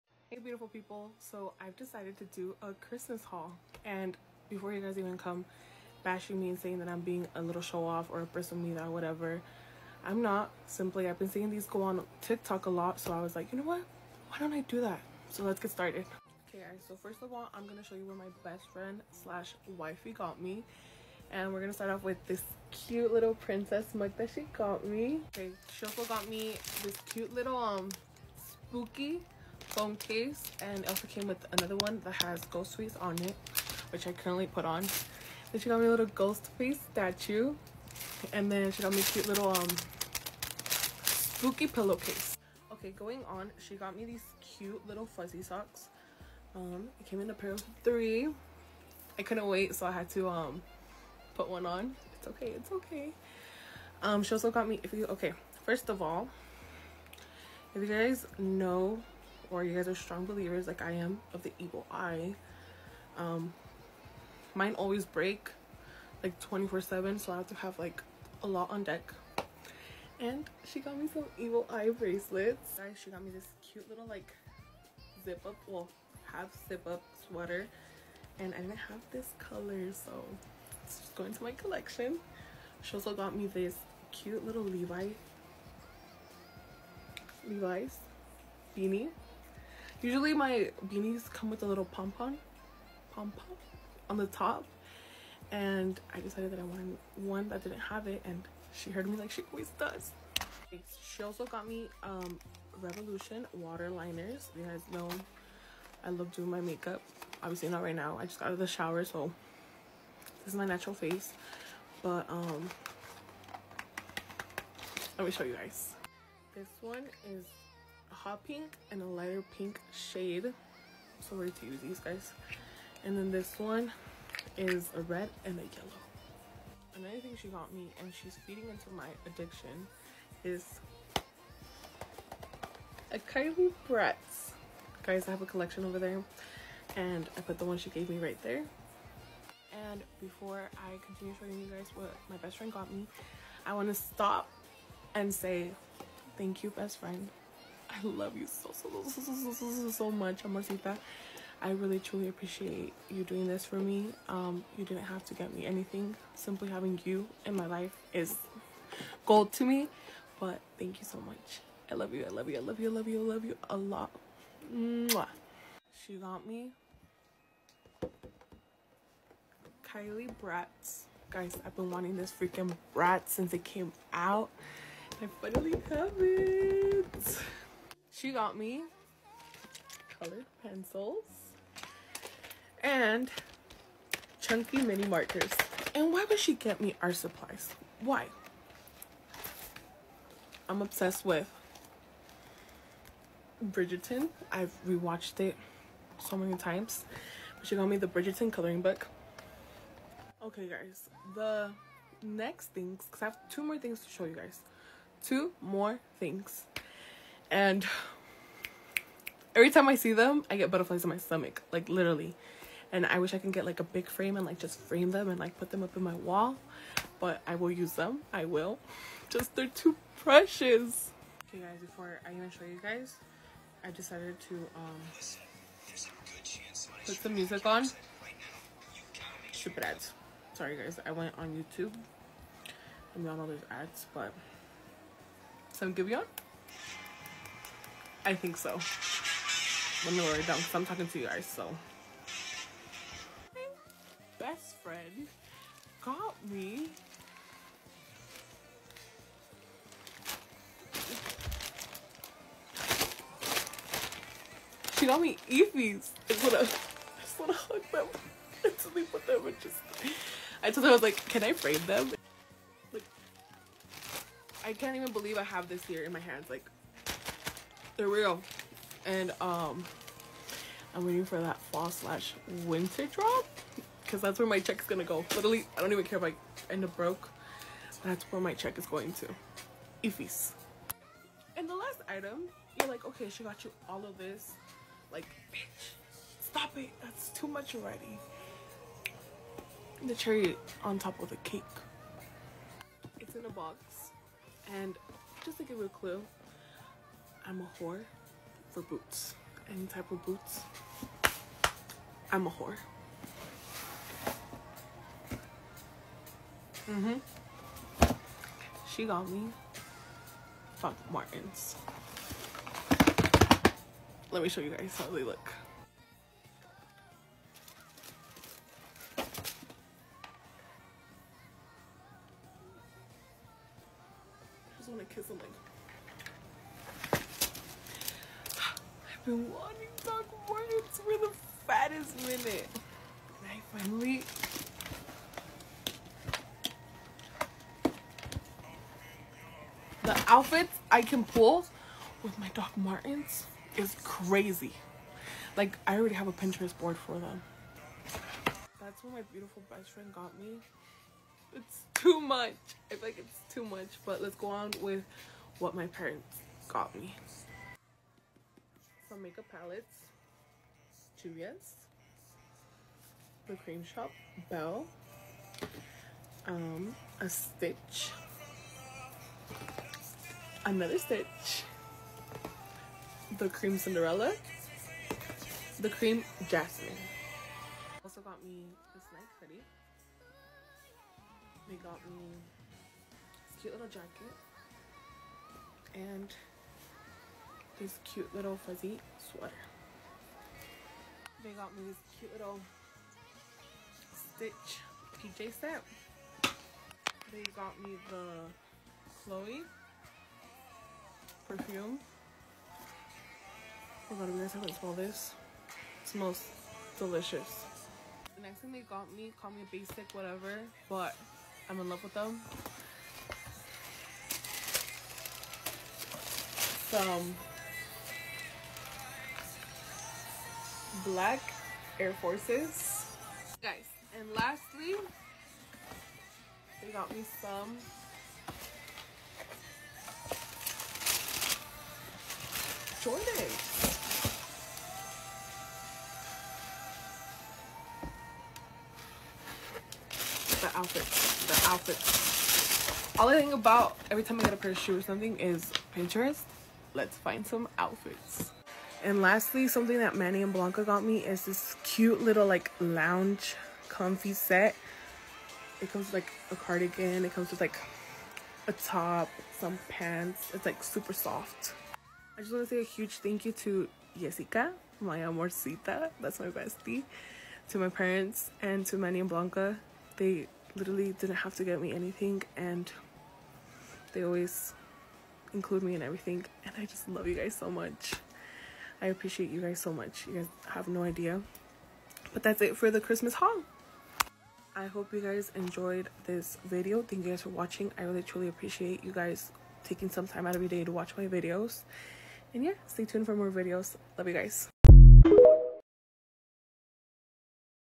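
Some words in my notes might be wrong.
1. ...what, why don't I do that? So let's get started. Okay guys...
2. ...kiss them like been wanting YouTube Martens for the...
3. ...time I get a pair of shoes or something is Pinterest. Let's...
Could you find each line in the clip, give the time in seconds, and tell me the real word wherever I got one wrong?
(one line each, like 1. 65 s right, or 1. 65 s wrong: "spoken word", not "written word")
1. 13 s right
2. 325 s wrong: "Doc", not "YouTube"
3. 444 s right.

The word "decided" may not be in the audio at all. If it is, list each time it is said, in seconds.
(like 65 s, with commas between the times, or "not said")
1 s, 96 s, 223 s.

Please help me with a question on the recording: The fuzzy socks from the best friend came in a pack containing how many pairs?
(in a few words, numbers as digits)
3.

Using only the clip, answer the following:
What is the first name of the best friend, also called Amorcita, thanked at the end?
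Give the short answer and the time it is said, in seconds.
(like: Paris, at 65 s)
Jessica, at 464 s.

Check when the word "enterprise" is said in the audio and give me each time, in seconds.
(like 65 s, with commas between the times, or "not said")
not said.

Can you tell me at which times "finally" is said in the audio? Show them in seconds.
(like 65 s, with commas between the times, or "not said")
175 s, 333 s.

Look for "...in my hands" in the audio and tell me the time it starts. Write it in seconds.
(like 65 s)
266 s.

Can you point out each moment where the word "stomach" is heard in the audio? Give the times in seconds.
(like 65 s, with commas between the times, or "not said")
211 s.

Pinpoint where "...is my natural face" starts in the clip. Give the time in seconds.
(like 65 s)
110 s.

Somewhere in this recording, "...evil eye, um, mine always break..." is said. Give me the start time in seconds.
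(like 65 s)
61 s.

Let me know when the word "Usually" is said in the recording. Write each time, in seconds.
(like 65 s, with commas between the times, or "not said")
90 s.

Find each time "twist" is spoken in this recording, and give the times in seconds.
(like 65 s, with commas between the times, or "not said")
not said.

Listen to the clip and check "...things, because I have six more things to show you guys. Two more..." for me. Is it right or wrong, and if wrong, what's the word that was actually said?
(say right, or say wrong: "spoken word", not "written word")
wrong: "two", not "six".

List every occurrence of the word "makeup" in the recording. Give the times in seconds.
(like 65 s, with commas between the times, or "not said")
106 s, 359 s.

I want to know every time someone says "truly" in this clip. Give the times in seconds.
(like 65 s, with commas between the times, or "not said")
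151 s, 488 s.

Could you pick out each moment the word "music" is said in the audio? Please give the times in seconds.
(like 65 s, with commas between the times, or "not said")
227 s.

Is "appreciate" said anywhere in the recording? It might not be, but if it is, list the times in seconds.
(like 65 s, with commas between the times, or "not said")
152 s, 479 s, 488 s.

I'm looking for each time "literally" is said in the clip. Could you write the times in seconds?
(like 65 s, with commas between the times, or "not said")
211 s, 275 s, 470 s.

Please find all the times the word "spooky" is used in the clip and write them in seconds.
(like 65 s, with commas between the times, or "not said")
28 s, 41 s.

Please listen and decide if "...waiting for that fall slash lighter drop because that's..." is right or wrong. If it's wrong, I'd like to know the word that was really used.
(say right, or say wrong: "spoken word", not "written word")
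wrong: "winter", not "lighter".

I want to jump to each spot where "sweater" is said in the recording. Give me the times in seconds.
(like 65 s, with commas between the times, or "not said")
77 s, 389 s.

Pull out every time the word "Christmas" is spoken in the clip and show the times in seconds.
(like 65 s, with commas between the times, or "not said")
2 s, 483 s.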